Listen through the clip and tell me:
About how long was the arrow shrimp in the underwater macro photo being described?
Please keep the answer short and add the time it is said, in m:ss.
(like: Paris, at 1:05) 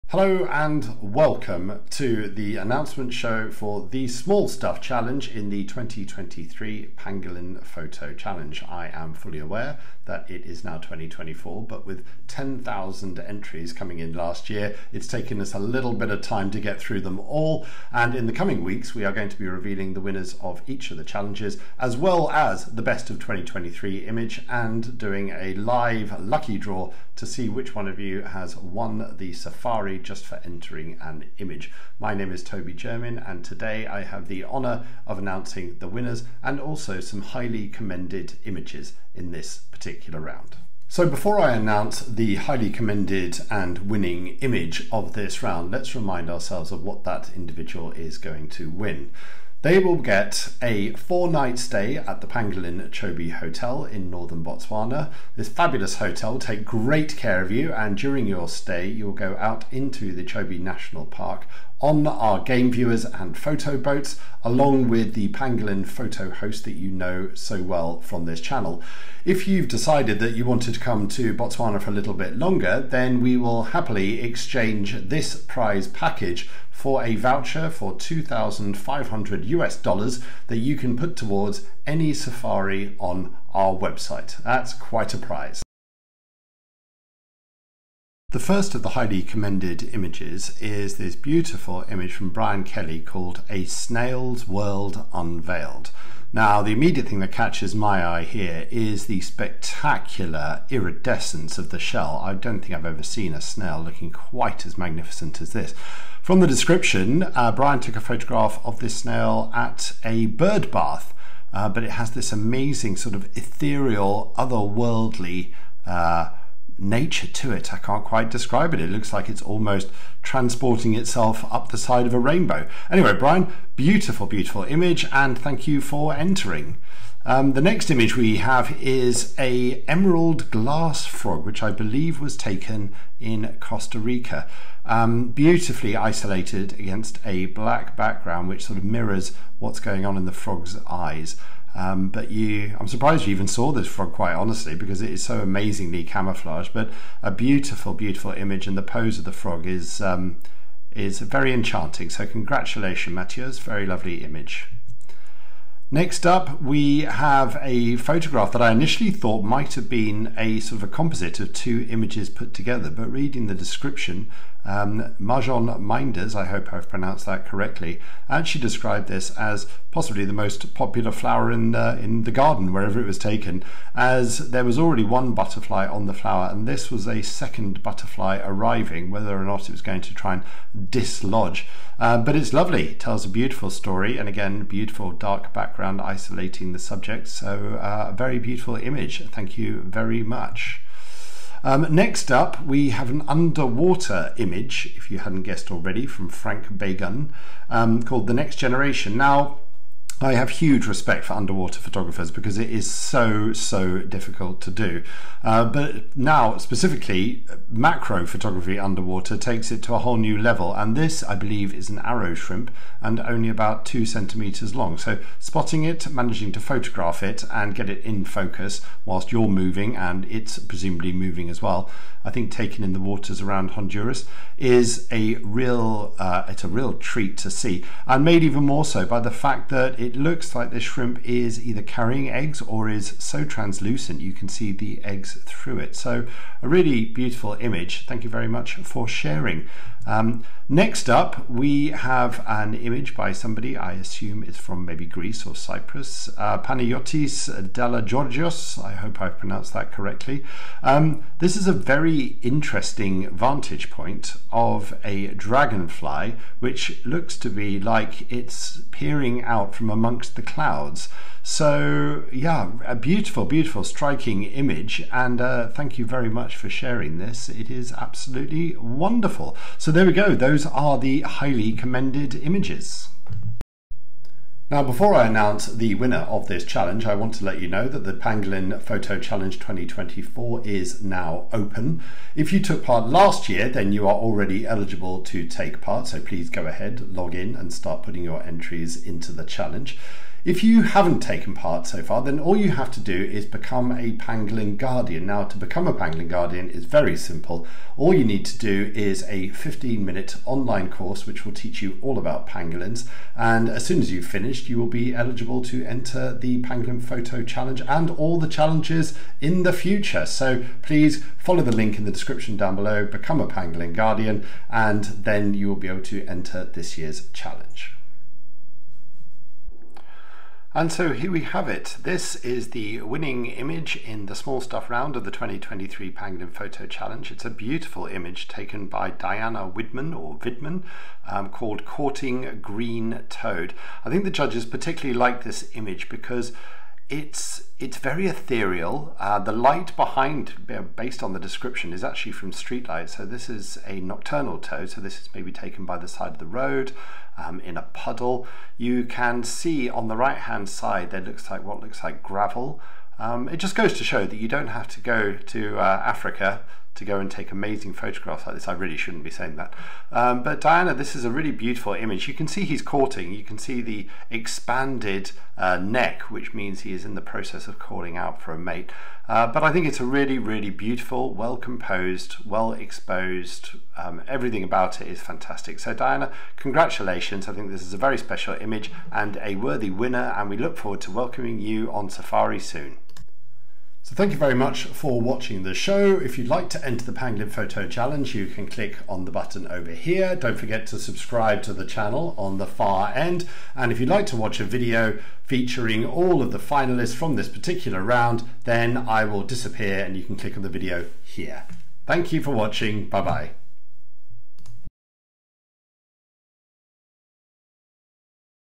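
2 centimeters, at 3:33.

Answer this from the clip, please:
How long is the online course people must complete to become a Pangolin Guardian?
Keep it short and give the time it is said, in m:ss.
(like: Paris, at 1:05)
15 minutes, at 4:59.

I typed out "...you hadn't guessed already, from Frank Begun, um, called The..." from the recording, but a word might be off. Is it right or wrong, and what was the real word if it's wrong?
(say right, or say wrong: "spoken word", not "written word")
right.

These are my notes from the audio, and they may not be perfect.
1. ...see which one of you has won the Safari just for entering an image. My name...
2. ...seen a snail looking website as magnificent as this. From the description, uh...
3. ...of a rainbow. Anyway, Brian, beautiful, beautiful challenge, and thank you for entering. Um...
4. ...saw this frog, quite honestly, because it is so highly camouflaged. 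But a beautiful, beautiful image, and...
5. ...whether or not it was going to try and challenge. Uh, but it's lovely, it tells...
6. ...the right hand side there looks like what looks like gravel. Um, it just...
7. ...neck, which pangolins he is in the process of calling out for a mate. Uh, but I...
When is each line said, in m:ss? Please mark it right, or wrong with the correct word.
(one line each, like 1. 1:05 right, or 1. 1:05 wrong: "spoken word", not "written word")
1. 0:27 right
2. 1:43 wrong: "quite", not "website"
3. 2:02 wrong: "image", not "challenge"
4. 2:23 wrong: "amazingly", not "highly"
5. 2:59 wrong: "dislodge", not "challenge"
6. 5:50 right
7. 6:05 wrong: "means", not "pangolins".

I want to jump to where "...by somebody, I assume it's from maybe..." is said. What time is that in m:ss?
4:03.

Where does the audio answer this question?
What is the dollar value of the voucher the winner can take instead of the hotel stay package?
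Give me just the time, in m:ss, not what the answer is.
1:17.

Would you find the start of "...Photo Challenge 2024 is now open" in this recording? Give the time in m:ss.
4:38.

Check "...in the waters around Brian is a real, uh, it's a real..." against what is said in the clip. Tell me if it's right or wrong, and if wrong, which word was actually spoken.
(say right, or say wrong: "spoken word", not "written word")
wrong: "Honduras", not "Brian".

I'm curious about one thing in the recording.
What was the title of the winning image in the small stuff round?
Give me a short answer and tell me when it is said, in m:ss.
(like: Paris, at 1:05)
Courting Green Toad, at 5:31.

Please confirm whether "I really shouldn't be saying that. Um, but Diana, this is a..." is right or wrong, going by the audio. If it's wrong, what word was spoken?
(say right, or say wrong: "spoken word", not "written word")
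right.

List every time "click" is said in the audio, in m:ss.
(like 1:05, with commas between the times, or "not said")
6:28, 6:40.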